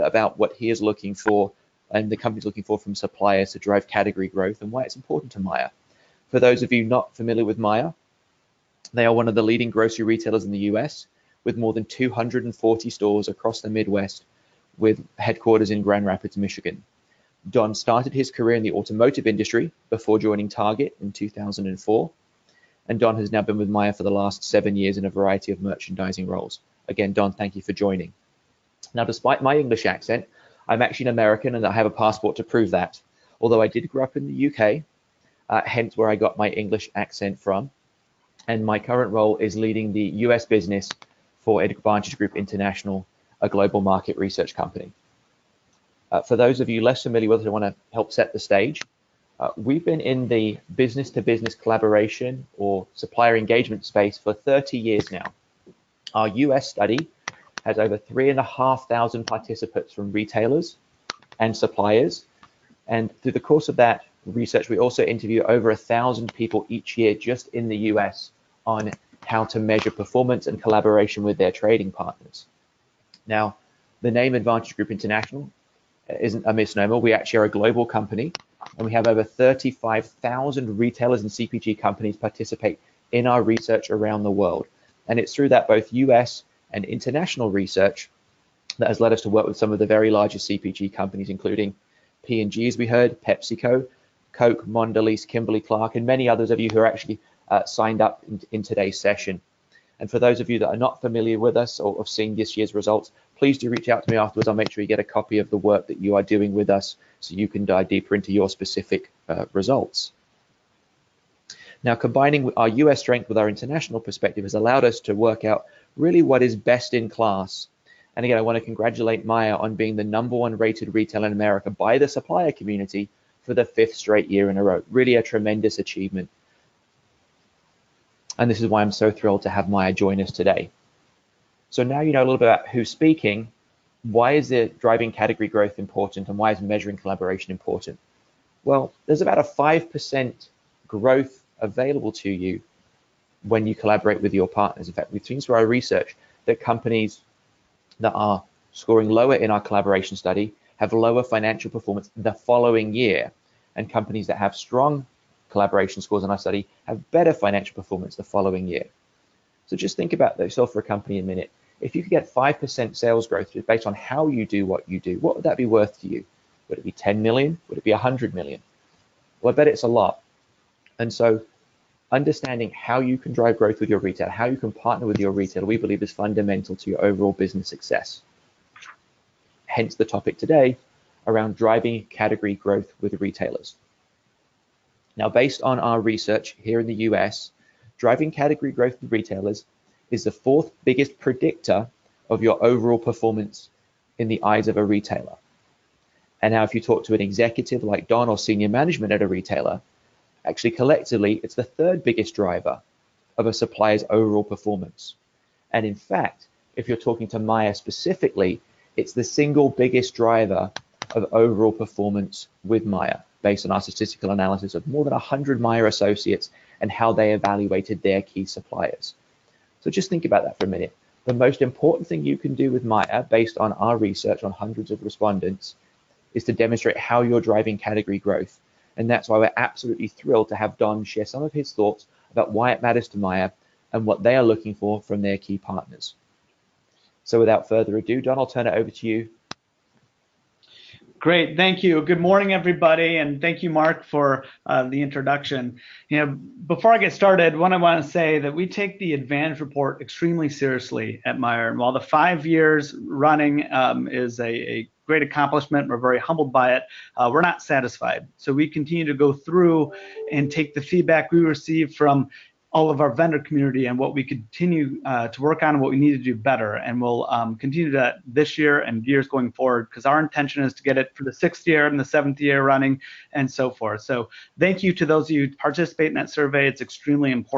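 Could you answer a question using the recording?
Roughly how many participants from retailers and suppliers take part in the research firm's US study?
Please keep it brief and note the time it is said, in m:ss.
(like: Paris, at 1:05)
3,500, at 0:57.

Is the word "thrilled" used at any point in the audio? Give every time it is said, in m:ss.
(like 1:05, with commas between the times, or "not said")
2:09, 3:50.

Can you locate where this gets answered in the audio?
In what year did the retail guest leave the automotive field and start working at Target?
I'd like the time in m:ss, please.
0:21.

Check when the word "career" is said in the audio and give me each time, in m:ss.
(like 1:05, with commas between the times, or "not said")
0:18.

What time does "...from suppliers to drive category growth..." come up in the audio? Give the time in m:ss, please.
0:02.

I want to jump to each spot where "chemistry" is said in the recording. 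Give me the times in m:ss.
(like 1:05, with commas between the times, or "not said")
not said.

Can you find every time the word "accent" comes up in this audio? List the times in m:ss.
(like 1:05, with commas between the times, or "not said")
0:29, 0:36.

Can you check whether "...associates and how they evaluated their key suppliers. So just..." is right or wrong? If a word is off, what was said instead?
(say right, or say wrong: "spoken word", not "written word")
right.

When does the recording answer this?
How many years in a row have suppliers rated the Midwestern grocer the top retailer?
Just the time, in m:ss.
2:03.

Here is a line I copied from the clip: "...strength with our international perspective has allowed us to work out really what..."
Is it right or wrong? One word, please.
right.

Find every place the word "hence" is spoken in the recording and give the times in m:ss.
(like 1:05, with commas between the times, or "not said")
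0:35, 2:59.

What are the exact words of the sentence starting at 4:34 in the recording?
So thank you to those of you participate in that survey.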